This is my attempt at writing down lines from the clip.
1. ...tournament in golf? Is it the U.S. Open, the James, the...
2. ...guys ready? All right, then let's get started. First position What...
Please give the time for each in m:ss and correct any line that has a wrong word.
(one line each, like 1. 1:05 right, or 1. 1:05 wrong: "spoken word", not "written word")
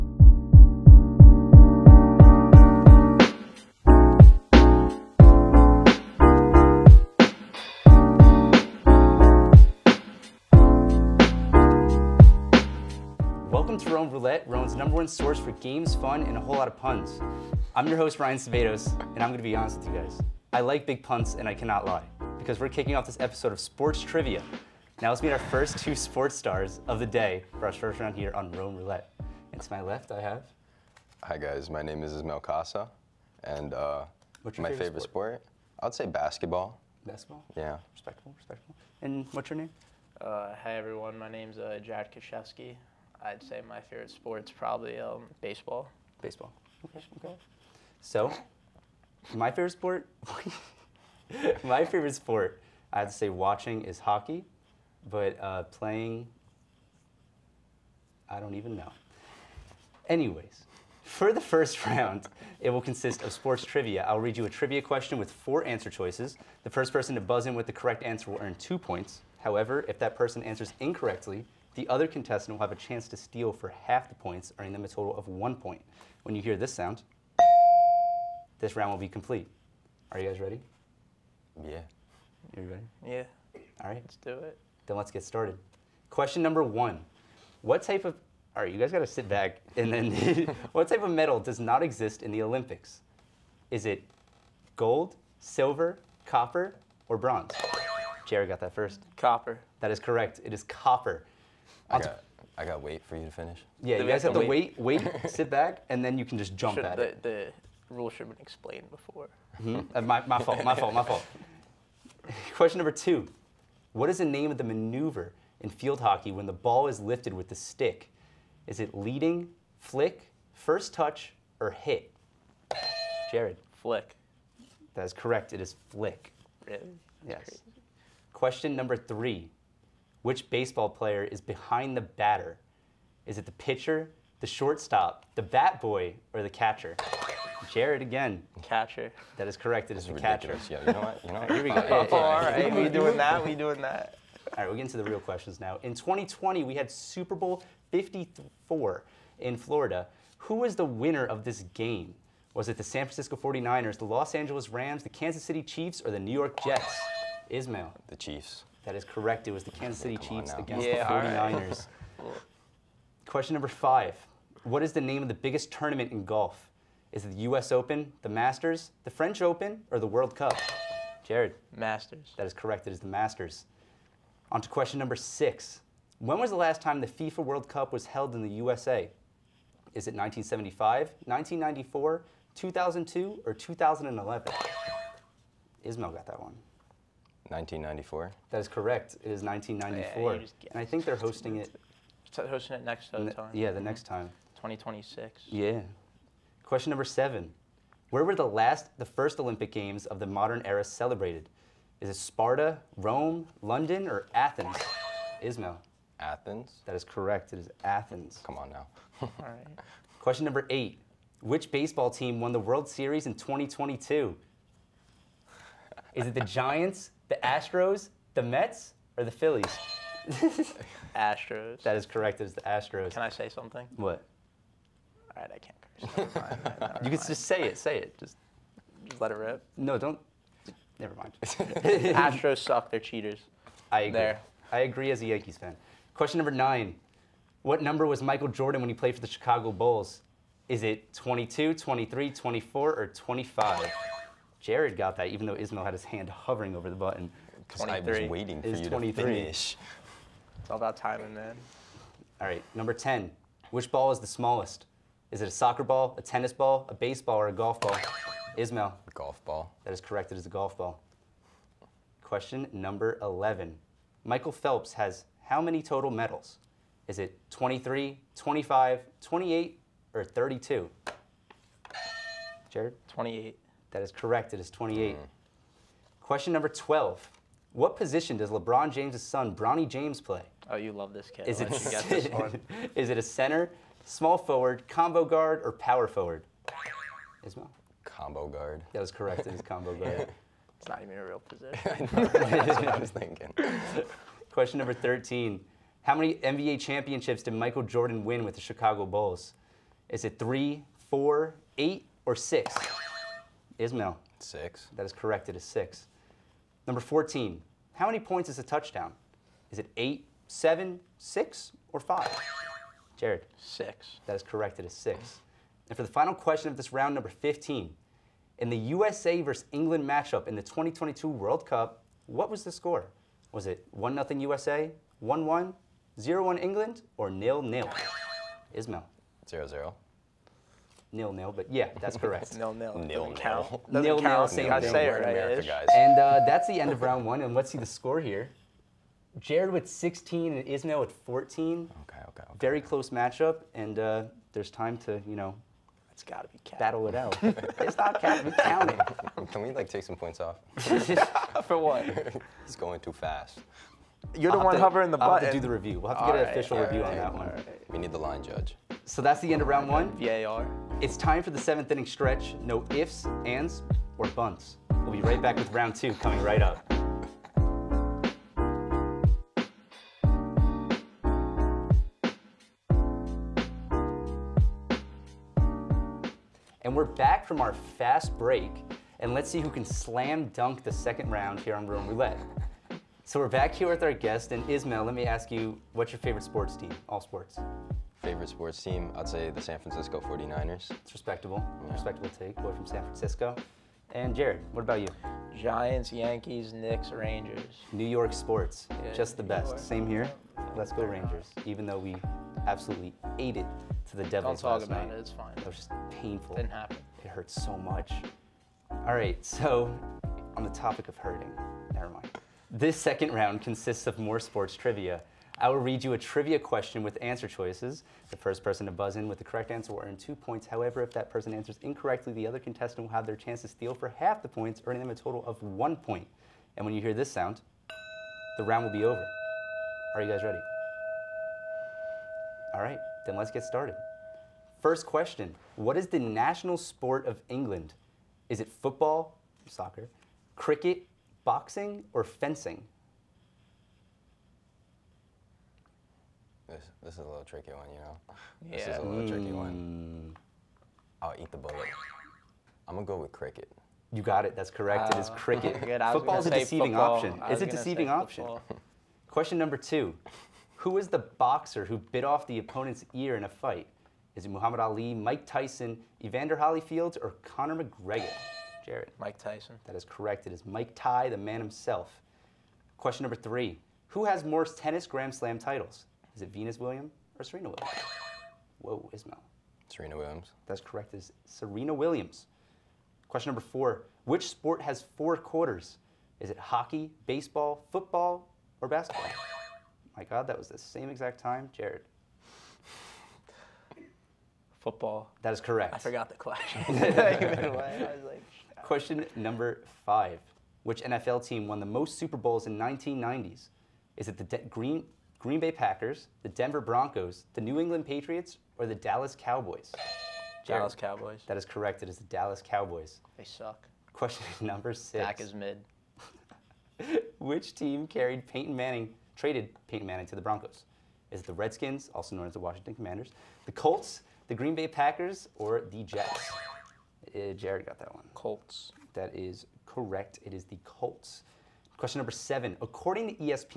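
1. 2:45 wrong: "Masters", not "James"
2. 7:10 wrong: "question", not "position".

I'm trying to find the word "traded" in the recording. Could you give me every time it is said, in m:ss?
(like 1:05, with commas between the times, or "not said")
8:39.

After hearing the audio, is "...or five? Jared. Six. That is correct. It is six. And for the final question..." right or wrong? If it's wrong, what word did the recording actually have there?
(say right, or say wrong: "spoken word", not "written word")
right.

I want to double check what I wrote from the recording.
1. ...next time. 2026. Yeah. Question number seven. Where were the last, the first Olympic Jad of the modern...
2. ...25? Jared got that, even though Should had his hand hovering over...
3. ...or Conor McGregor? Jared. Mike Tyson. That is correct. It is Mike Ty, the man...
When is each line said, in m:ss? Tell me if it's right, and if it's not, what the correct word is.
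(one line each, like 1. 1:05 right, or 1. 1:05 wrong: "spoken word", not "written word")
1. 3:13 wrong: "Games", not "Jad"
2. 4:03 wrong: "Ismail", not "Should"
3. 7:47 right.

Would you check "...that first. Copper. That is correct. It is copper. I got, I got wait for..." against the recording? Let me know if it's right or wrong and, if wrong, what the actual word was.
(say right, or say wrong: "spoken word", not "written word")
right.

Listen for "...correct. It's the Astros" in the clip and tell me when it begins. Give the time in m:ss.
3:42.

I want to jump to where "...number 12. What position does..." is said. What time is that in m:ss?
4:36.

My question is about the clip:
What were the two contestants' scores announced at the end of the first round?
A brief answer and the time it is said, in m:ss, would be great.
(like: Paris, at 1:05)
16 and 14, at 5:39.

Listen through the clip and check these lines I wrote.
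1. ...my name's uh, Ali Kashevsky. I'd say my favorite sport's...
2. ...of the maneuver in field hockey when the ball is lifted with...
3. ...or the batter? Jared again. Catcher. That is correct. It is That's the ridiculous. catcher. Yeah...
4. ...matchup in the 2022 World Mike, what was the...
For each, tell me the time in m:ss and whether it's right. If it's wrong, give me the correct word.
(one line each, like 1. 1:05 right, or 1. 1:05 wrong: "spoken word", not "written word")
1. 0:41 wrong: "Jad", not "Ali"
2. 1:54 right
3. 2:16 wrong: "catcher", not "batter"
4. 5:20 wrong: "Cup", not "Mike".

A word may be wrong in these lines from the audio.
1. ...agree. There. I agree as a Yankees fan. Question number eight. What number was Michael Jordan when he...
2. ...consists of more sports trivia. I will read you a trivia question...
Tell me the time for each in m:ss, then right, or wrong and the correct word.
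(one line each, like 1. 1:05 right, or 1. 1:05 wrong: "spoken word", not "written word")
1. 3:54 wrong: "nine", not "eight"
2. 6:53 right.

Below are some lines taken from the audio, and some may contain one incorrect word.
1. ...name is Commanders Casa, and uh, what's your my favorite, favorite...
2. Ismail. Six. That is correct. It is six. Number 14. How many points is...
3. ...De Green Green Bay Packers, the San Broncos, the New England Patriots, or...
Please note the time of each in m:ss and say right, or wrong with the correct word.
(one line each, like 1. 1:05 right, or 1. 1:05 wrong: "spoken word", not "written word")
1. 0:31 wrong: "Ismail", not "Commanders"
2. 5:03 right
3. 8:24 wrong: "Denver", not "San".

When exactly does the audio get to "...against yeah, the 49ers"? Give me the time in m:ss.
2:40.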